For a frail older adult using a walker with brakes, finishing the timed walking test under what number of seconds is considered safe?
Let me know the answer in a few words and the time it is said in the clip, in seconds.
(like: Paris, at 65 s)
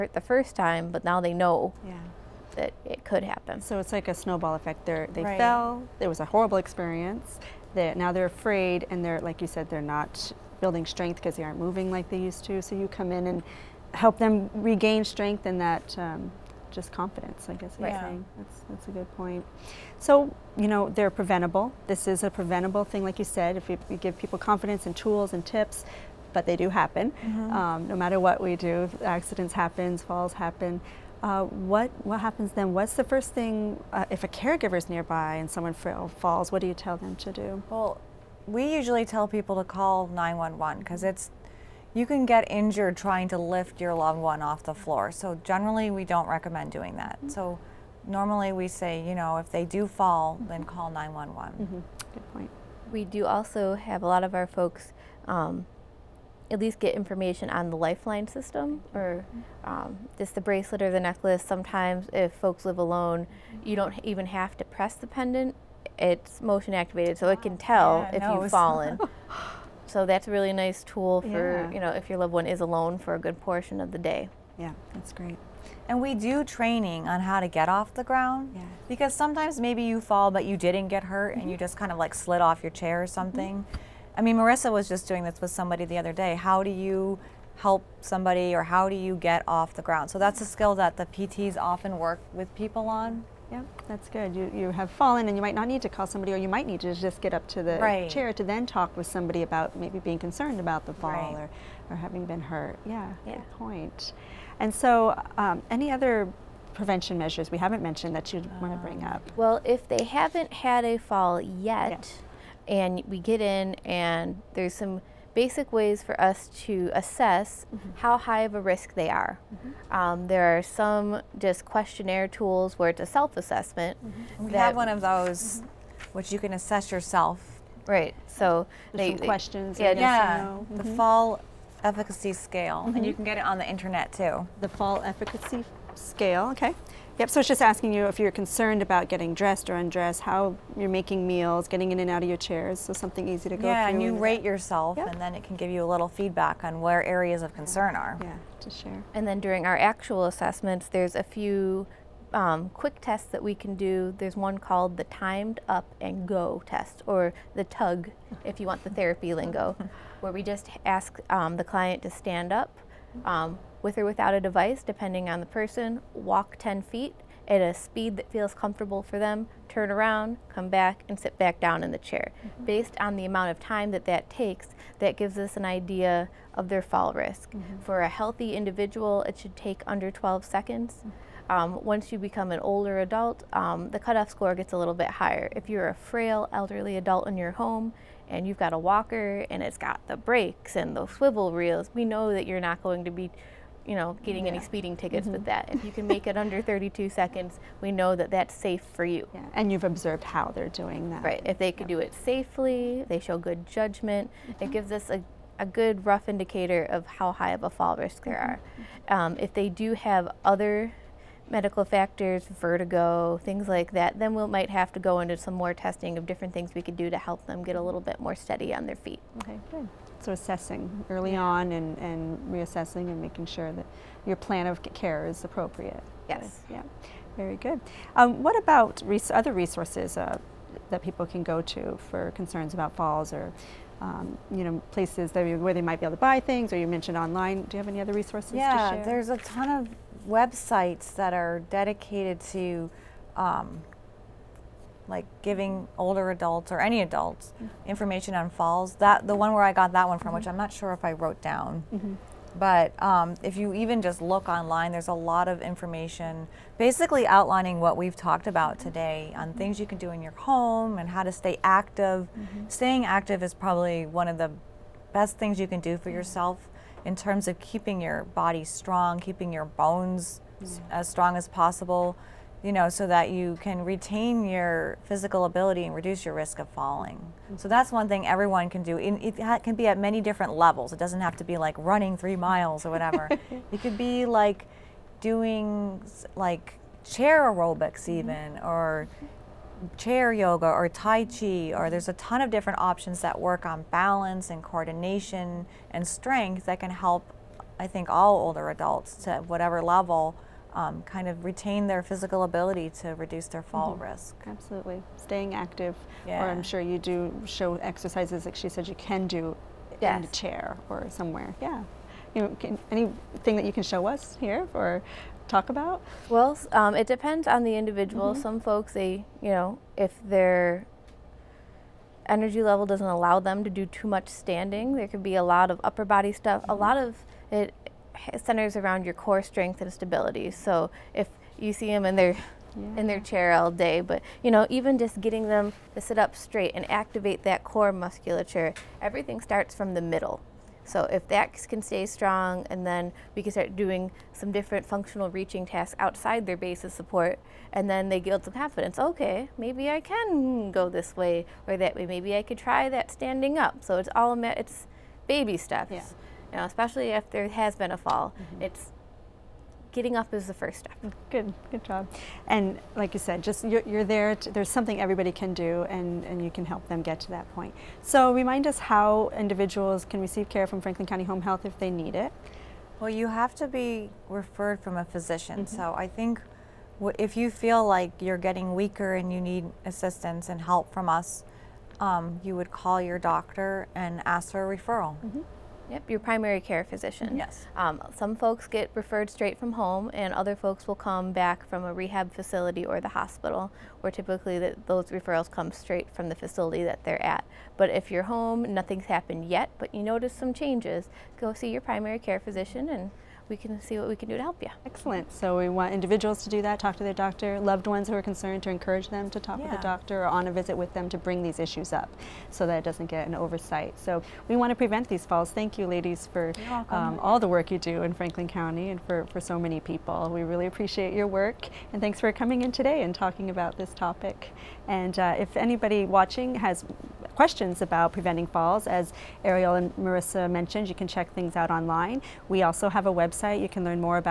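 32, at 196 s.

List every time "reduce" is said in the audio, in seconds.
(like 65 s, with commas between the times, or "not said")
275 s, 303 s.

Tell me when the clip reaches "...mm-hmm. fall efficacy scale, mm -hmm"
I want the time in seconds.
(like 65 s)
130 s.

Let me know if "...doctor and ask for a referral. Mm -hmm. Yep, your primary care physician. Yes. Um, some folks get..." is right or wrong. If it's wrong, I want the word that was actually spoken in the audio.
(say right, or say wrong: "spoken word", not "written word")
right.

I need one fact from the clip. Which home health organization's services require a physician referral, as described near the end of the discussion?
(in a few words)
Franklin County Home Health.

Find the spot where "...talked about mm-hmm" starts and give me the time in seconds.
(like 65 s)
258 s.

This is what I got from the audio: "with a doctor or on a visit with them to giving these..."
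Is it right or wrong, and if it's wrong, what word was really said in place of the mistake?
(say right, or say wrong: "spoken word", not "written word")
wrong: "bring", not "giving".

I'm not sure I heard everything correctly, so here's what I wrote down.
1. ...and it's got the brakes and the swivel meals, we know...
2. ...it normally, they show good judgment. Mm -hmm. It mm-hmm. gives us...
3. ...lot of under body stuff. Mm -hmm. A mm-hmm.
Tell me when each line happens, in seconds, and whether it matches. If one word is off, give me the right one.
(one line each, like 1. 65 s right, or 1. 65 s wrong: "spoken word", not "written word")
1. 189 s wrong: "reels", not "meals"
2. 202 s wrong: "safely", not "normally"
3. 325 s wrong: "upper", not "under".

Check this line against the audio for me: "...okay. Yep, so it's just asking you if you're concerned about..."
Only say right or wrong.
right.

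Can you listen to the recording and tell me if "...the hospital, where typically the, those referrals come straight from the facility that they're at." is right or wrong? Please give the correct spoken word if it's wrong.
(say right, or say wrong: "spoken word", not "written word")
right.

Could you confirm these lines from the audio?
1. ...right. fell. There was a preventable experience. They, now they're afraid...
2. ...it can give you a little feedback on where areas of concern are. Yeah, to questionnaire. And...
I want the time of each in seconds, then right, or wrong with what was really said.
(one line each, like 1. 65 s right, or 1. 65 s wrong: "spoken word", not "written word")
1. 5 s wrong: "horrible", not "preventable"
2. 145 s wrong: "share", not "questionnaire".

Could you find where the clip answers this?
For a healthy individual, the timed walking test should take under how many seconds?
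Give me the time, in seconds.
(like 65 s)
180 s.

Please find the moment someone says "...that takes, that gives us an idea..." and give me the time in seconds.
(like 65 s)
174 s.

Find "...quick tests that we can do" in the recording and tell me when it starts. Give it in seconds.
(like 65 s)
152 s.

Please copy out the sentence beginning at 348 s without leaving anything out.
Okay, maybe I can go this way or that way.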